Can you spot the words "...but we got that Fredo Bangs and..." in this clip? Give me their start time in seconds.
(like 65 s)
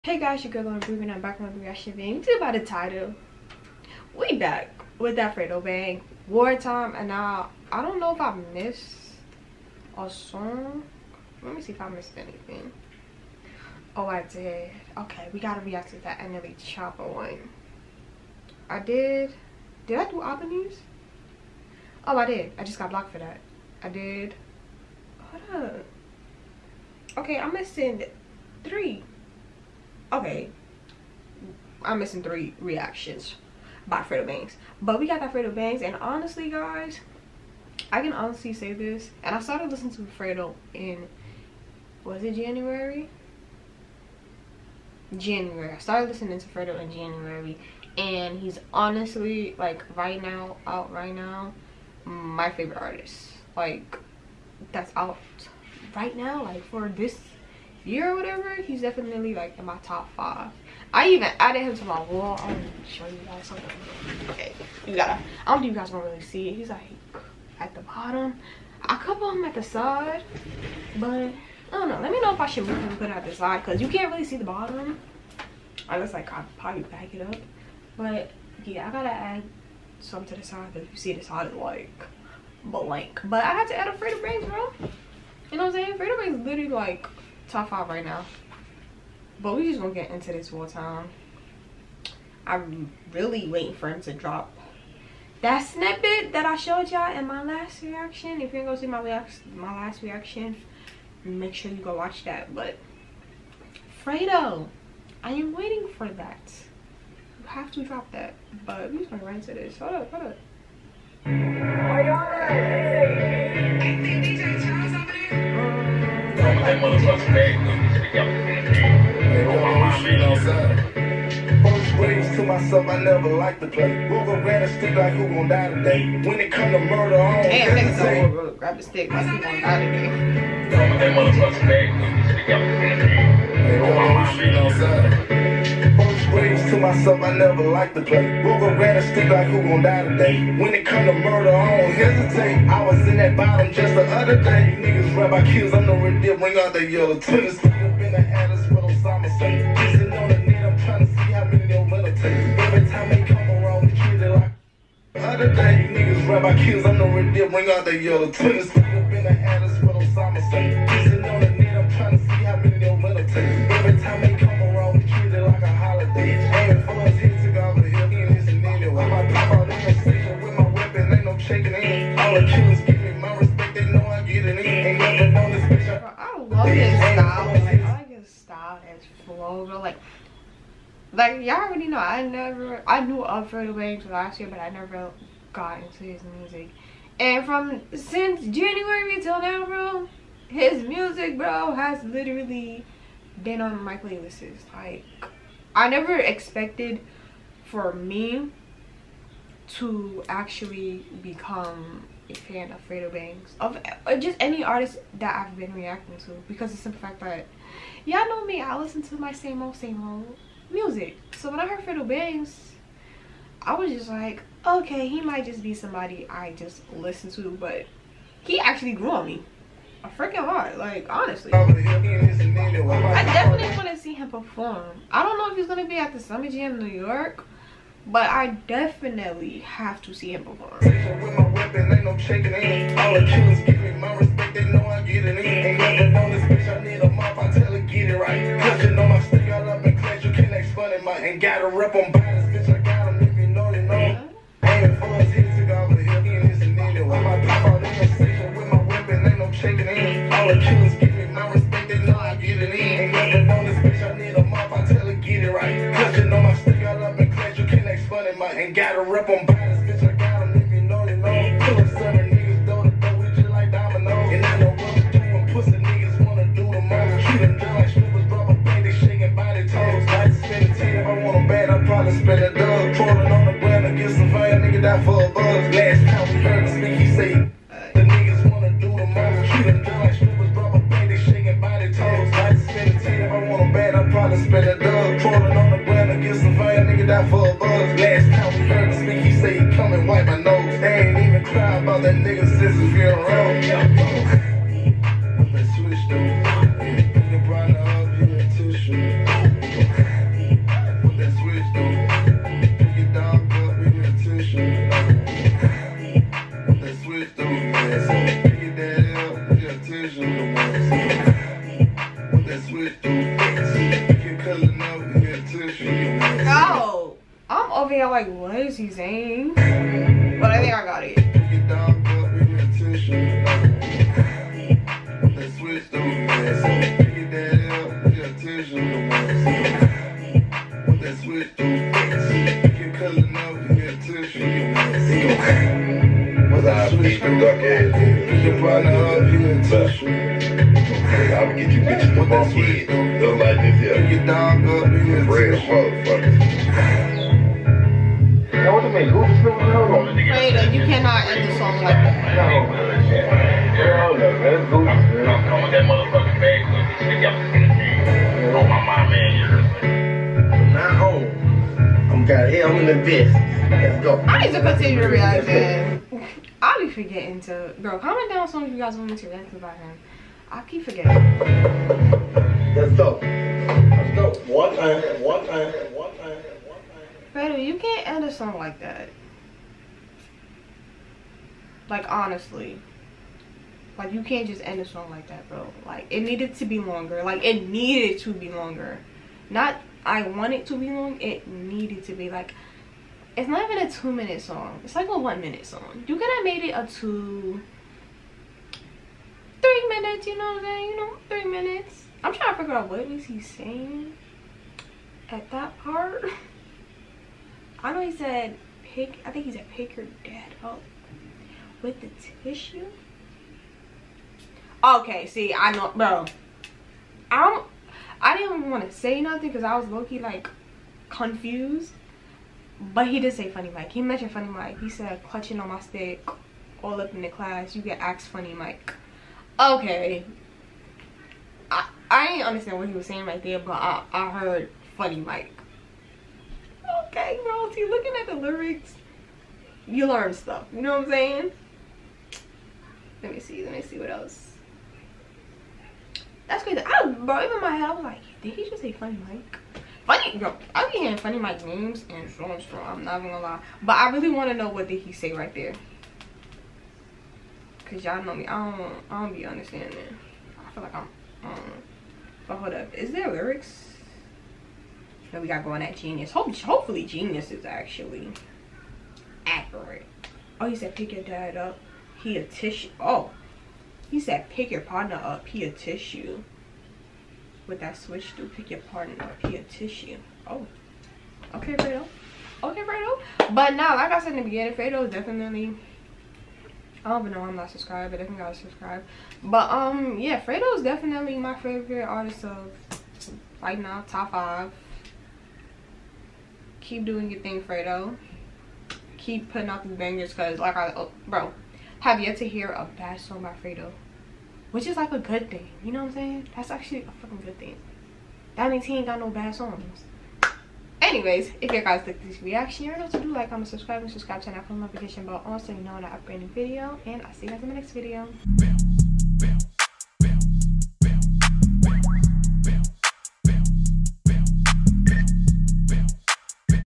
34 s.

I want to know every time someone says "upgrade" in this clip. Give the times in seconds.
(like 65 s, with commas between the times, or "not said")
516 s.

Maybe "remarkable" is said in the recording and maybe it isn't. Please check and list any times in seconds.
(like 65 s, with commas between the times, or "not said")
not said.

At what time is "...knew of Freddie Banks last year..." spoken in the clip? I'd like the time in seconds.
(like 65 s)
183 s.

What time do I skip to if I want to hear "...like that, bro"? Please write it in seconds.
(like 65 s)
385 s.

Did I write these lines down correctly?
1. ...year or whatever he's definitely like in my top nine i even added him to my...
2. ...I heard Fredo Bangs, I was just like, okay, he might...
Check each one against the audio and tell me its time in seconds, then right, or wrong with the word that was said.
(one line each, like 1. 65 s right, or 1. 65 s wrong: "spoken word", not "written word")
1. 57 s wrong: "five", not "nine"
2. 211 s right.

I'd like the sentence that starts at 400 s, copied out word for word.
You know, three minutes I'm trying to figure out what is he saying at that part.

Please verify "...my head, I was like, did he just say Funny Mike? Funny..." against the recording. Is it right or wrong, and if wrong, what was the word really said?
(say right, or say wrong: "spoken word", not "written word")
right.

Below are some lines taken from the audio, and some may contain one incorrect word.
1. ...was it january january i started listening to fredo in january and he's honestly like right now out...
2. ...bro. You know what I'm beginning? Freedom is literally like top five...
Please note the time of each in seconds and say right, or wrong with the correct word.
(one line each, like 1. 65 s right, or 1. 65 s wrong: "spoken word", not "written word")
1. 42 s right
2. 84 s wrong: "saying", not "beginning".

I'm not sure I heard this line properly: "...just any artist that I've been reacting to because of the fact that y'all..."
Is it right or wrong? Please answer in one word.
right.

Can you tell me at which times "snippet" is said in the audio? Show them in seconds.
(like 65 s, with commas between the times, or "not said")
95 s.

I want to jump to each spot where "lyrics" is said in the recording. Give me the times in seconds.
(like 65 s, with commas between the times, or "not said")
438 s, 463 s.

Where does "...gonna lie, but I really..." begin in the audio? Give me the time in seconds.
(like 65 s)
453 s.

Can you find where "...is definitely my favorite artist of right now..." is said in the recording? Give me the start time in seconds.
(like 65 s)
490 s.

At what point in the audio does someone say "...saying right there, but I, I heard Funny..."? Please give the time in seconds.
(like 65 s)
433 s.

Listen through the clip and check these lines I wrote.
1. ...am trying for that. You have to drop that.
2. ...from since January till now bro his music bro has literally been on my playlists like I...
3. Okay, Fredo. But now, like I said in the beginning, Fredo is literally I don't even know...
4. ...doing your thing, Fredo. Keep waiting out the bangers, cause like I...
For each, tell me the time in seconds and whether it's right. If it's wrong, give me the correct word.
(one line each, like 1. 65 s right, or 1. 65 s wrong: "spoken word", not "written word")
1. 105 s wrong: "waiting", not "trying"
2. 187 s right
3. 482 s wrong: "definitely", not "literally"
4. 497 s wrong: "putting", not "waiting".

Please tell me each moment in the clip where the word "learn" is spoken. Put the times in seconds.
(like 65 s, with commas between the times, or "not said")
440 s.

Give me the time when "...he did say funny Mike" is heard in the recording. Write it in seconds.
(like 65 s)
423 s.